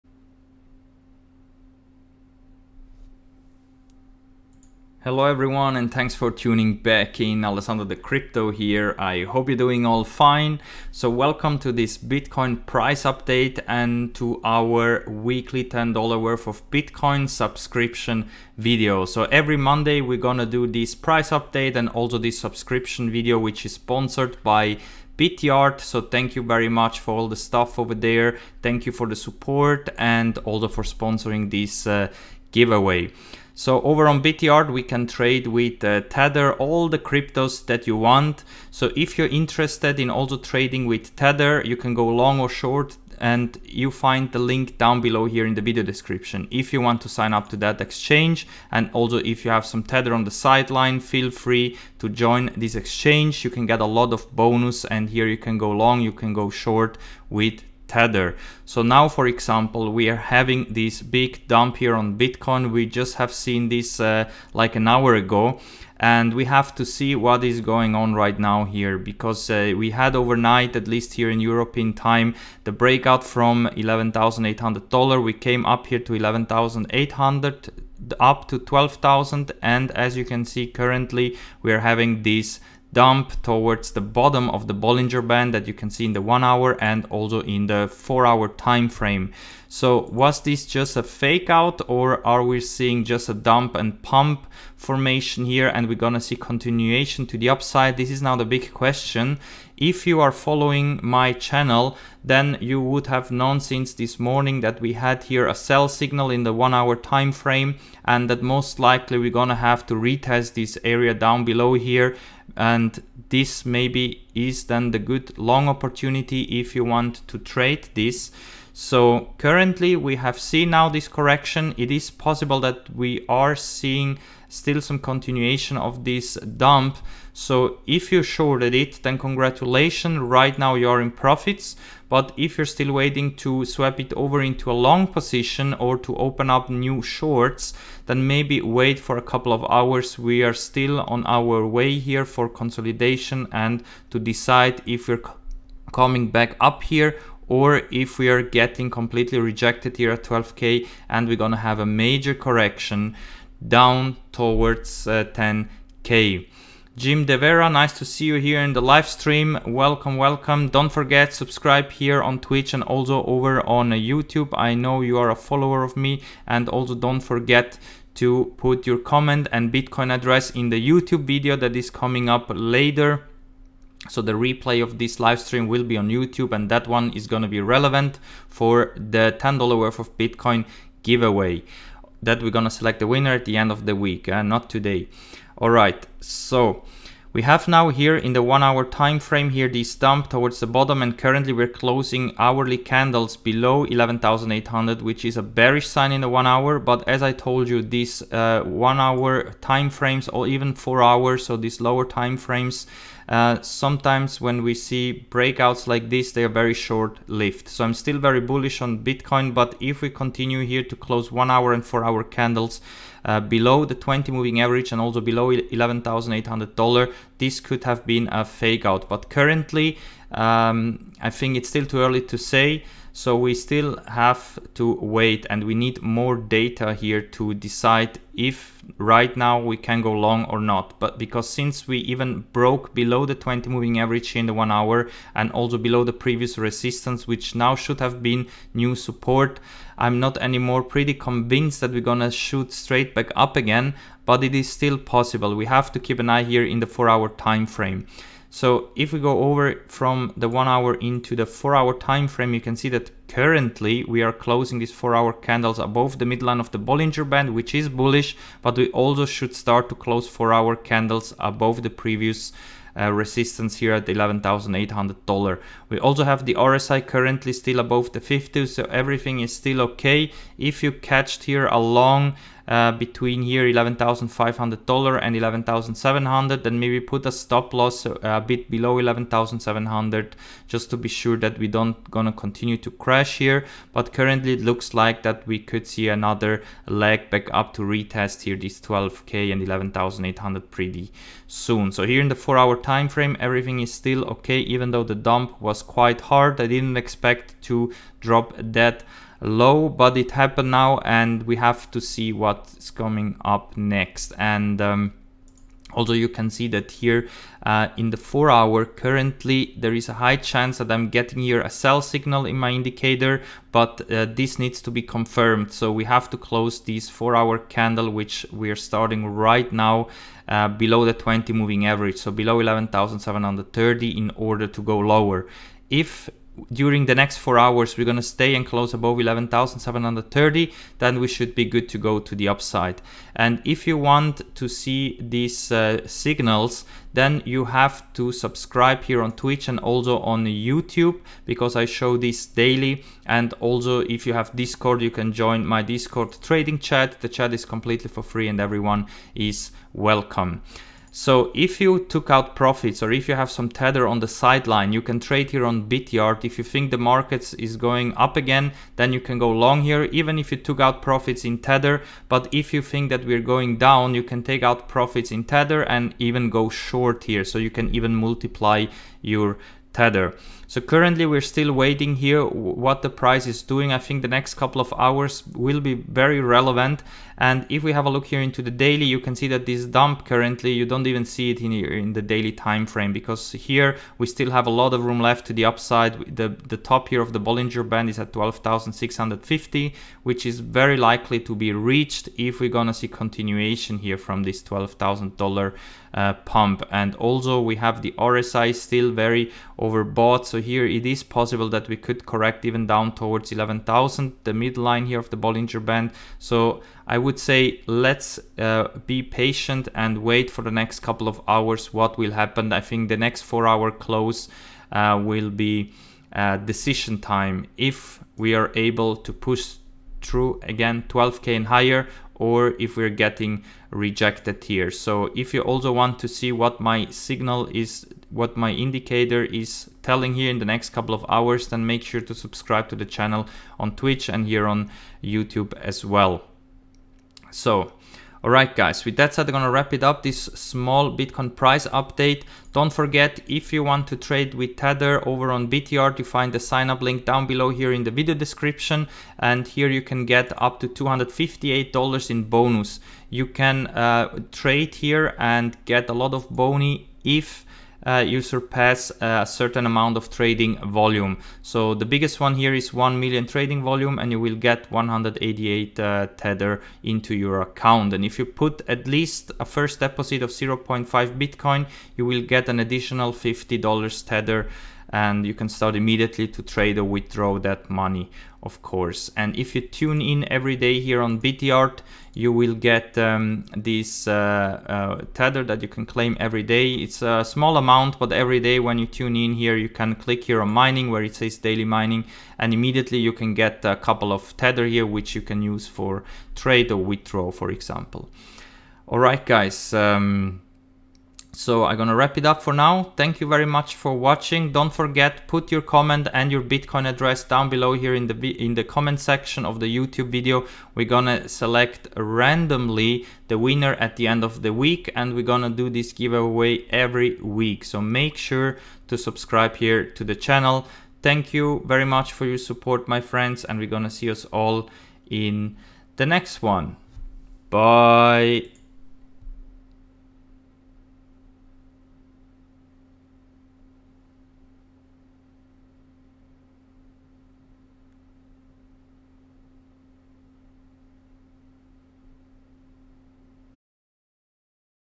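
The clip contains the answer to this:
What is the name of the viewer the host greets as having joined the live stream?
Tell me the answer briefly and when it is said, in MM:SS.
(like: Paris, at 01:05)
Jim De Vera, at 02:36.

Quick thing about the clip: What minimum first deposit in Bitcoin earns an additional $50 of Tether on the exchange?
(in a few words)
0.5 Bitcoin.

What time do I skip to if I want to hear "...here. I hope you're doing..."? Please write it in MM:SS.
00:08.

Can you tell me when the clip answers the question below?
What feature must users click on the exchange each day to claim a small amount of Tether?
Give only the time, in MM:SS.
08:11.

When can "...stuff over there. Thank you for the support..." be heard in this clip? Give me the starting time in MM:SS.
00:27.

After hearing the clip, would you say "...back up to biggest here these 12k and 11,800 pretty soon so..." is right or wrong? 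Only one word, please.
wrong.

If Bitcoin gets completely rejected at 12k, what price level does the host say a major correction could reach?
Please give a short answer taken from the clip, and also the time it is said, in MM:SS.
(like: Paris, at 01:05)
10k, at 02:35.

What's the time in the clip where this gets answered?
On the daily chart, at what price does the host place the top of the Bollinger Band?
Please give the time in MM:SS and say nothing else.
06:28.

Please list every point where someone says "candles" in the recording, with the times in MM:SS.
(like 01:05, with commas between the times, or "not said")
03:12, 03:32, 04:15, 04:20, 05:17.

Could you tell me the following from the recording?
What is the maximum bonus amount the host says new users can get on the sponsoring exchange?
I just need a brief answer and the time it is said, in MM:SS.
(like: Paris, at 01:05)
$258, at 07:30.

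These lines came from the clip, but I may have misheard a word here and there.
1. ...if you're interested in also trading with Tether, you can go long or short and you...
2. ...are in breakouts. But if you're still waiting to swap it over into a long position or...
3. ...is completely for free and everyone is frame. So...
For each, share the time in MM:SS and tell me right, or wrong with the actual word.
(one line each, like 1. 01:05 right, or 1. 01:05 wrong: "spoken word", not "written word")
1. 00:38 right
2. 02:10 wrong: "profits", not "breakouts"
3. 05:47 wrong: "welcome", not "frame".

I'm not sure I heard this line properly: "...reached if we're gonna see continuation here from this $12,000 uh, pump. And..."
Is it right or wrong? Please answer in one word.
right.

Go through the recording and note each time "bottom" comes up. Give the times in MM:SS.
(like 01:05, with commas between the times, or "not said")
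01:24, 03:10.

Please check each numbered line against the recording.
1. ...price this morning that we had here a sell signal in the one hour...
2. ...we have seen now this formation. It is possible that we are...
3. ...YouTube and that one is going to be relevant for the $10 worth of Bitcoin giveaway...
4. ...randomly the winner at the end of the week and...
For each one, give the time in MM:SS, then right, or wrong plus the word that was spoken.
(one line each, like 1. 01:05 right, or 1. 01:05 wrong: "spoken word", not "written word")
1. 01:43 wrong: "since", not "price"
2. 01:59 wrong: "correction", not "formation"
3. 02:56 right
4. 08:32 right.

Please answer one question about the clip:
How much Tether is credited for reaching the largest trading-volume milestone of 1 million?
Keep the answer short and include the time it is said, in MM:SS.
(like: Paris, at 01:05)
188, at 07:44.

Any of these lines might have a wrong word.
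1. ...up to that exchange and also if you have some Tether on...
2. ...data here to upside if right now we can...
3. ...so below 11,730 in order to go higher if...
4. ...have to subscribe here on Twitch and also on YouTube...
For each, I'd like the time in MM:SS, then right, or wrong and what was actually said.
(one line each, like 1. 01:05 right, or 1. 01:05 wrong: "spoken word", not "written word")
1. 00:47 right
2. 03:46 wrong: "decide", not "upside"
3. 05:22 wrong: "lower", not "higher"
4. 05:37 right.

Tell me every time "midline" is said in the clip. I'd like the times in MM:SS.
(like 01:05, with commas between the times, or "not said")
04:16, 06:44.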